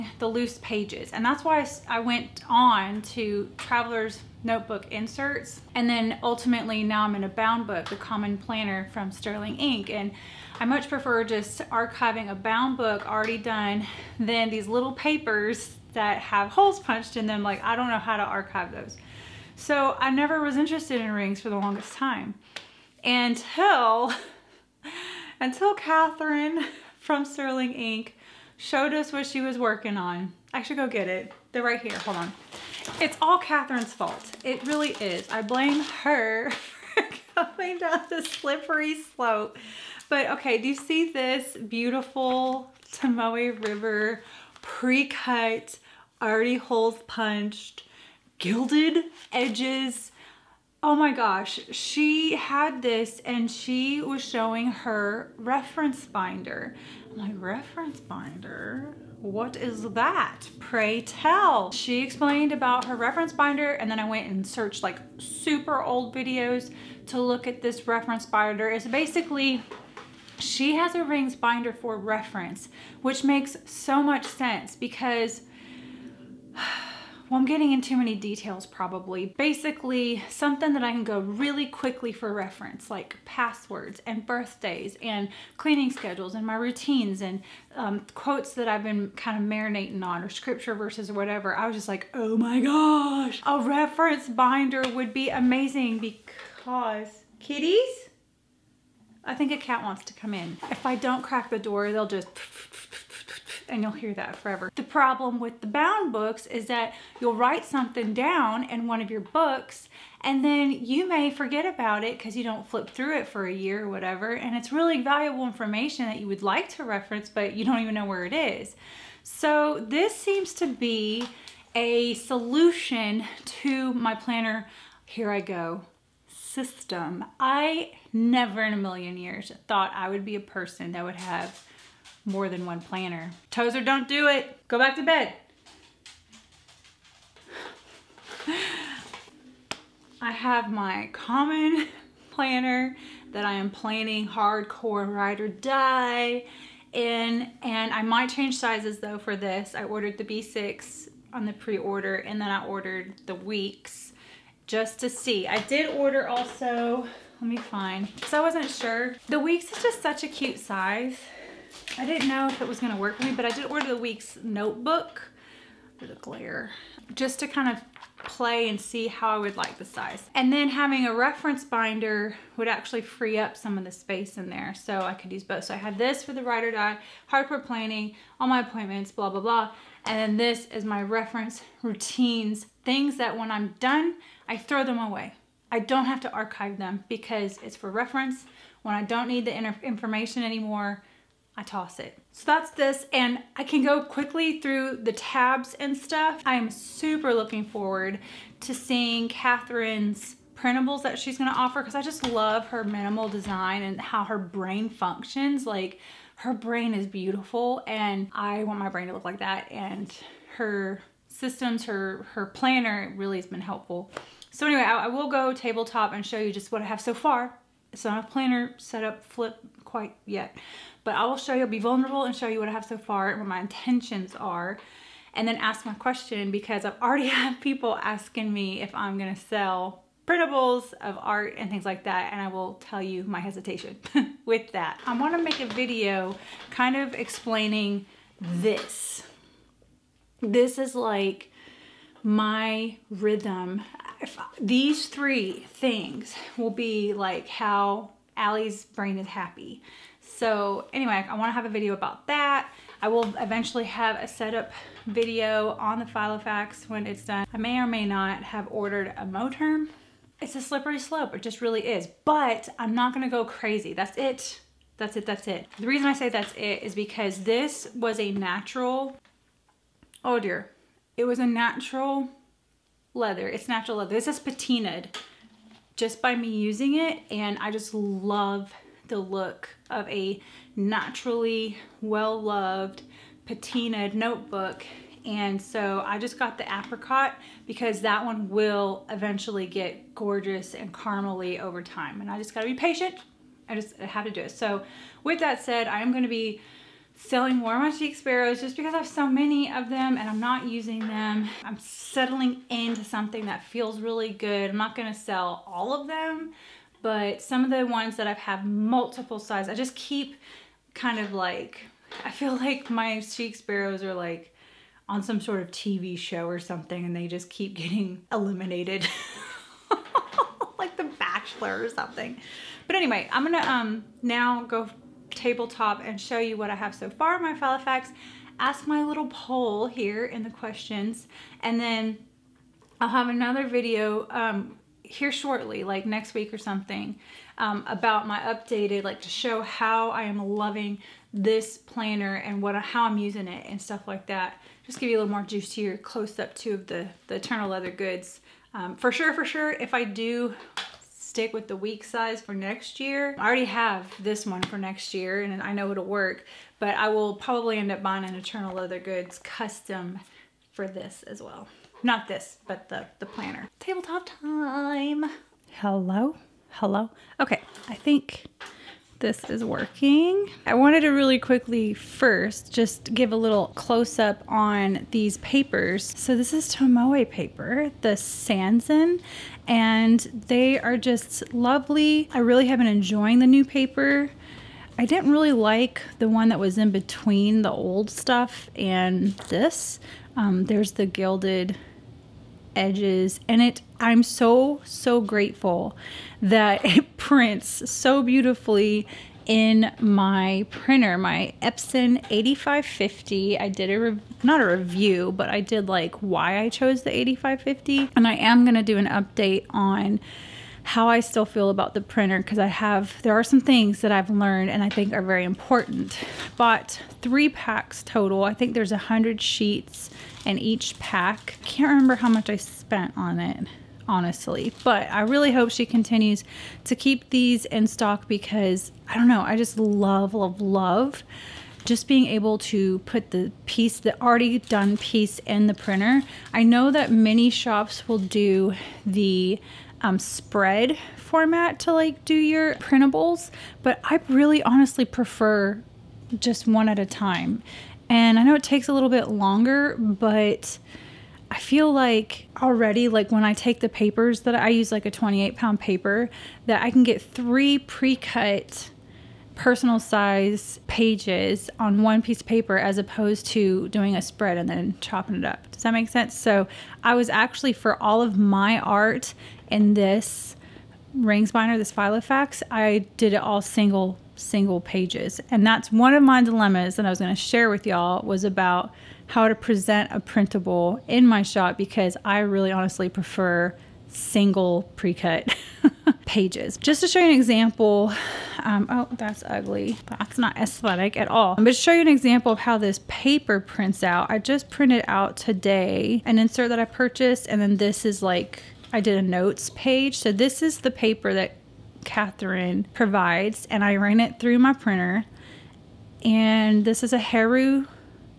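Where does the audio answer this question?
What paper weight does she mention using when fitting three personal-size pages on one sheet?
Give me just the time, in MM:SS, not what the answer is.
07:35.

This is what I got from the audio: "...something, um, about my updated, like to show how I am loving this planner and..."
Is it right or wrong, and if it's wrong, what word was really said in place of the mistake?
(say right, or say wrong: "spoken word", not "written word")
right.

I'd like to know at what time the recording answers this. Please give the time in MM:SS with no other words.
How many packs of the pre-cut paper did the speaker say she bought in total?
06:57.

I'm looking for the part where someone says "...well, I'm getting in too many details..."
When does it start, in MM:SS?
01:17.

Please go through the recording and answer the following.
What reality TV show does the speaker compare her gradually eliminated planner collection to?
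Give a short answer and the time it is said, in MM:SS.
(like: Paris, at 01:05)
The Bachelor, at 05:20.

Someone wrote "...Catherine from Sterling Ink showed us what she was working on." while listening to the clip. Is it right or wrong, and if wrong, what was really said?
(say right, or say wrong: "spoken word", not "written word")
right.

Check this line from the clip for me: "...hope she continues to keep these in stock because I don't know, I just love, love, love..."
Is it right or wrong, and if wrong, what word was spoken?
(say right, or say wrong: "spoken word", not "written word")
right.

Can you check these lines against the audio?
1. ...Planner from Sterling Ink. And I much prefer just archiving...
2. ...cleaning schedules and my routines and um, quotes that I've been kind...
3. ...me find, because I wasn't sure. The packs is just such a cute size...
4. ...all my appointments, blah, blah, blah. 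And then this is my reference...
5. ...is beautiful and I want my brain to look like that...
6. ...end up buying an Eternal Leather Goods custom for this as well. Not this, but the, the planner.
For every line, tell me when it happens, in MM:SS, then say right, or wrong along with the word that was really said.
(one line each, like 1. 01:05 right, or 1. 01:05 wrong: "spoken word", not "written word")
1. 00:08 right
2. 01:25 right
3. 02:37 wrong: "weeks", not "packs"
4. 02:58 right
5. 03:26 right
6. 05:57 right.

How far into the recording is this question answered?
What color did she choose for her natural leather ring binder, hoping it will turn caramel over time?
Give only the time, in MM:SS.
04:46.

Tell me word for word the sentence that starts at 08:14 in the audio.
I just printed out today an insert that I purchased, and then this is like, I did a notes page.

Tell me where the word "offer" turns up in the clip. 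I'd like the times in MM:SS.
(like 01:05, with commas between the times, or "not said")
03:21.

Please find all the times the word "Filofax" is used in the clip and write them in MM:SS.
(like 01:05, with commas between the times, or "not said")
04:16, 05:27, 07:51.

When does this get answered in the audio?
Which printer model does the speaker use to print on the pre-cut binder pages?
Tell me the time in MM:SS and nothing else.
06:41.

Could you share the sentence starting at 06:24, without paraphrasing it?
I didn't really like the one that was in between the old stuff and this.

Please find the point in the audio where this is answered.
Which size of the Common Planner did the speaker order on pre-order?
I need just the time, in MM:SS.
02:30.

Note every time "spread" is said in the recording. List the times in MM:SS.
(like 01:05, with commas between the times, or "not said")
07:20, 07:44.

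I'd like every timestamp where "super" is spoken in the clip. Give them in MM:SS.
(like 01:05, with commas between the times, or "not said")
01:05, 03:16.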